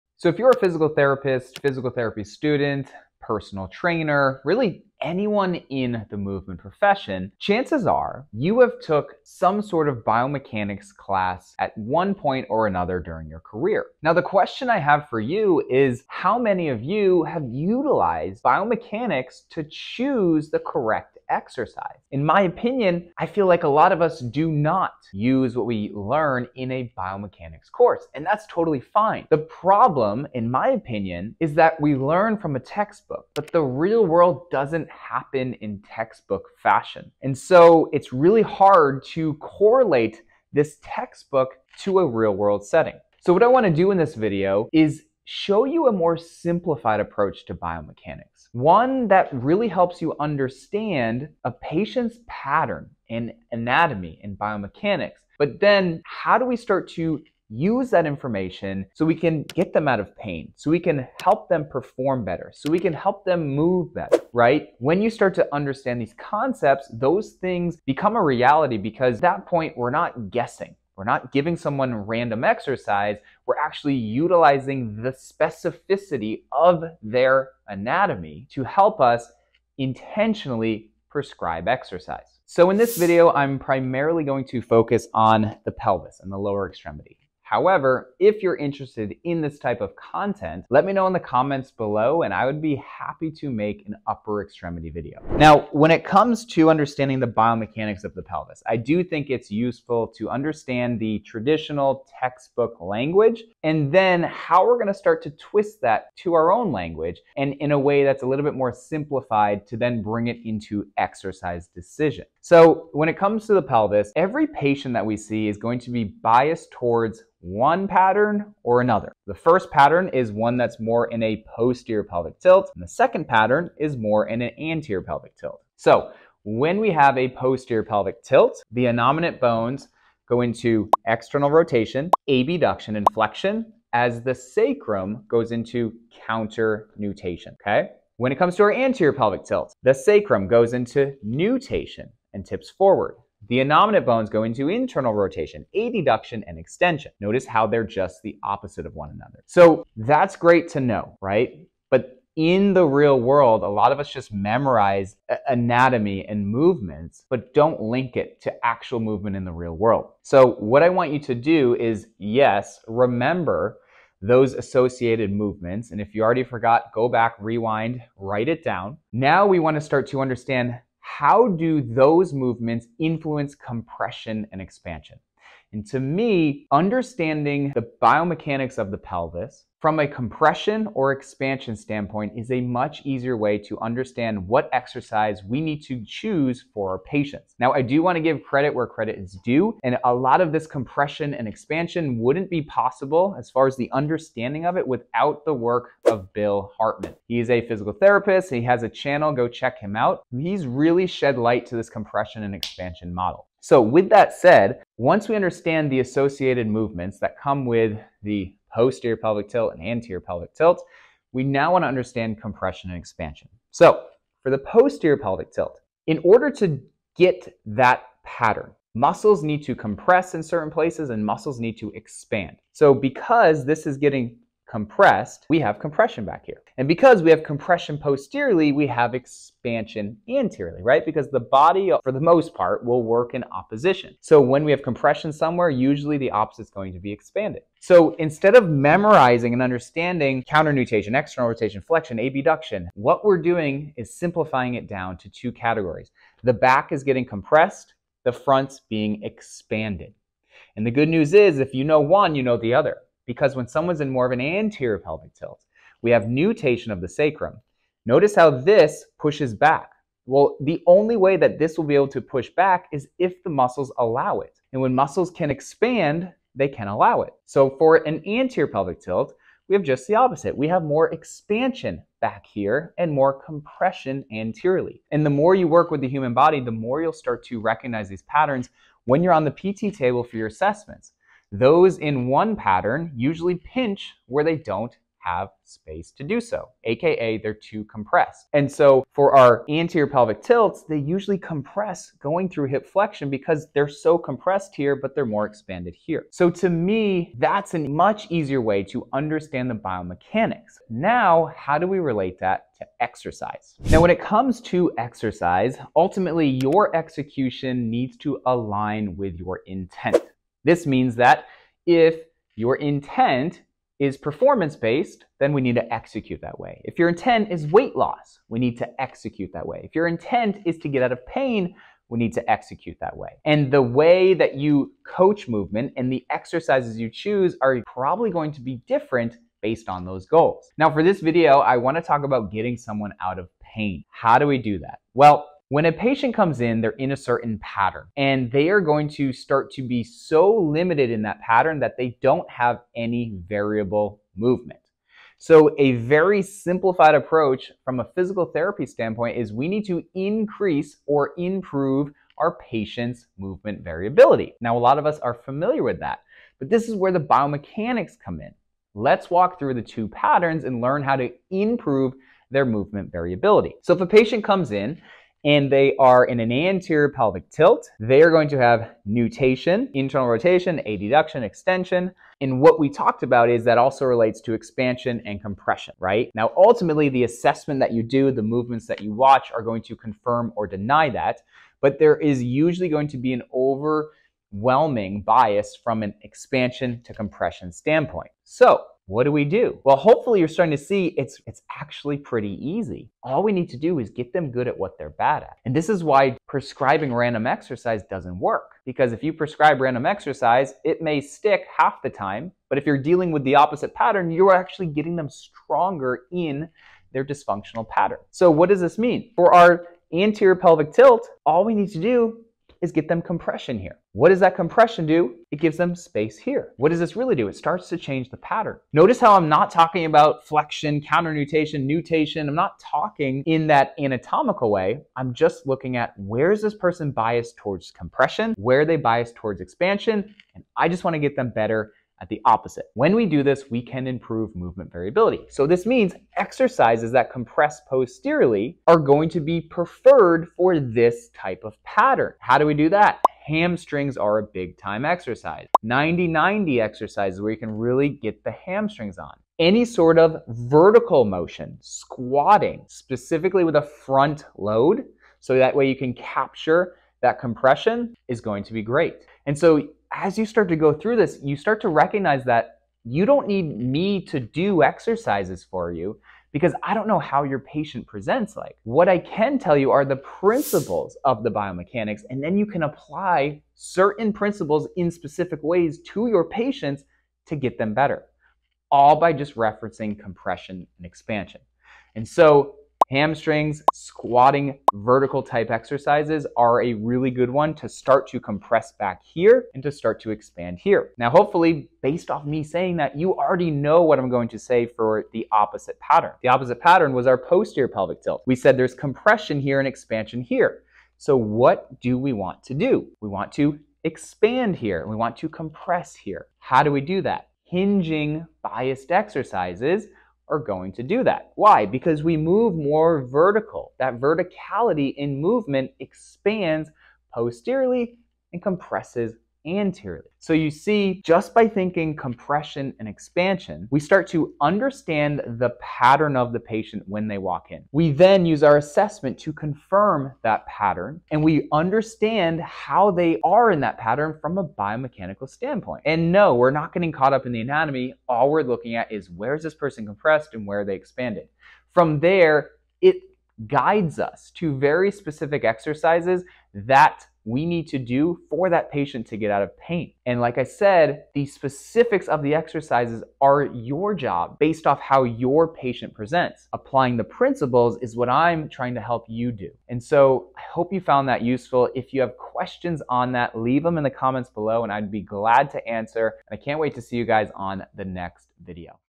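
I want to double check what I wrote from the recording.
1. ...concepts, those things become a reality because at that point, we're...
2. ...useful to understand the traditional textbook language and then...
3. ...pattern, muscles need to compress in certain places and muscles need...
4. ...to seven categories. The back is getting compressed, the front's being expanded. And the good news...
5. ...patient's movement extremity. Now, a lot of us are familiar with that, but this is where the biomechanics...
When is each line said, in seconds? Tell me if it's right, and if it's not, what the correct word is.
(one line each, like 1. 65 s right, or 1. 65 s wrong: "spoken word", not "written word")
1. 66 s right
2. 99 s right
3. 218 s right
4. 245 s wrong: "two", not "seven"
5. 352 s wrong: "variability", not "extremity".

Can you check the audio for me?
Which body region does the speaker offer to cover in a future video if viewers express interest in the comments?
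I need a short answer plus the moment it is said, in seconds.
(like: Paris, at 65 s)
Upper extremity, at 94 s.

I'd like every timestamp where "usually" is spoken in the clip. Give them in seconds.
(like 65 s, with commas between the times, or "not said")
235 s, 283 s, 290 s, 382 s.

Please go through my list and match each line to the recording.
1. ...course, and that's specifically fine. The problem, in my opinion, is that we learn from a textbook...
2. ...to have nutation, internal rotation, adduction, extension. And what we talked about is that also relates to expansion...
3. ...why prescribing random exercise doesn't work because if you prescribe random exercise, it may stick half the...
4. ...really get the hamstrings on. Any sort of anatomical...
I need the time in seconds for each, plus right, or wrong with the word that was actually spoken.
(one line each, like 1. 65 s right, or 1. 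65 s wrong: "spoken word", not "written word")
1. 27 s wrong: "totally", not "specifically"
2. 368 s right
3. 396 s right
4. 447 s wrong: "vertical", not "anatomical".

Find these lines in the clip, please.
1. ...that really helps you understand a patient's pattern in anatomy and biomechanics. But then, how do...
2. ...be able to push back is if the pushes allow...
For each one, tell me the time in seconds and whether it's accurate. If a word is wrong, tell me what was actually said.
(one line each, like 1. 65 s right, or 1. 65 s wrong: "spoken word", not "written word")
1. 49 s right
2. 261 s wrong: "muscles", not "pushes".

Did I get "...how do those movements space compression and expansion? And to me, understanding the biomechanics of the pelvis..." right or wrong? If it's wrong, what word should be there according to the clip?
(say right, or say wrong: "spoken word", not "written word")
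wrong: "influence", not "space".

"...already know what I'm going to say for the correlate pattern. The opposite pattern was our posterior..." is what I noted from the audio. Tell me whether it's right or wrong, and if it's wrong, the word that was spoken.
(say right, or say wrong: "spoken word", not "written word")
wrong: "opposite", not "correlate".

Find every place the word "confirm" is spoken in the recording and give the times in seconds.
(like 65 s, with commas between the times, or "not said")
379 s, 529 s.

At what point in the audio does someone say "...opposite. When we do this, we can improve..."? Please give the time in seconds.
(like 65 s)
432 s.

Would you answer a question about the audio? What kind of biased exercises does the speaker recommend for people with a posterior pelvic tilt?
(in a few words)
Hinging.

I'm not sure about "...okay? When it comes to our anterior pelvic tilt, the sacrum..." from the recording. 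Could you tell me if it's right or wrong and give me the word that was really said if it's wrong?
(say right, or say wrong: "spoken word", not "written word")
right.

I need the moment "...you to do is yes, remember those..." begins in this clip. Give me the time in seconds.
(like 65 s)
161 s.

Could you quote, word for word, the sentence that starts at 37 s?
And so it's really hard to correlate this textbook to a real world setting.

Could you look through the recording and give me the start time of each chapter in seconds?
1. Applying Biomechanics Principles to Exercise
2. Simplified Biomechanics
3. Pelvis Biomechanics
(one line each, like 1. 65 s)
1. 305 s
2. 169 s
3. 96 s.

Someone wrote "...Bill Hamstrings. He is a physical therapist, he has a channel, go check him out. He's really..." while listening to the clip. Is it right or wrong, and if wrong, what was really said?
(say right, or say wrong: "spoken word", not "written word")
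wrong: "Hartman", not "Hamstrings".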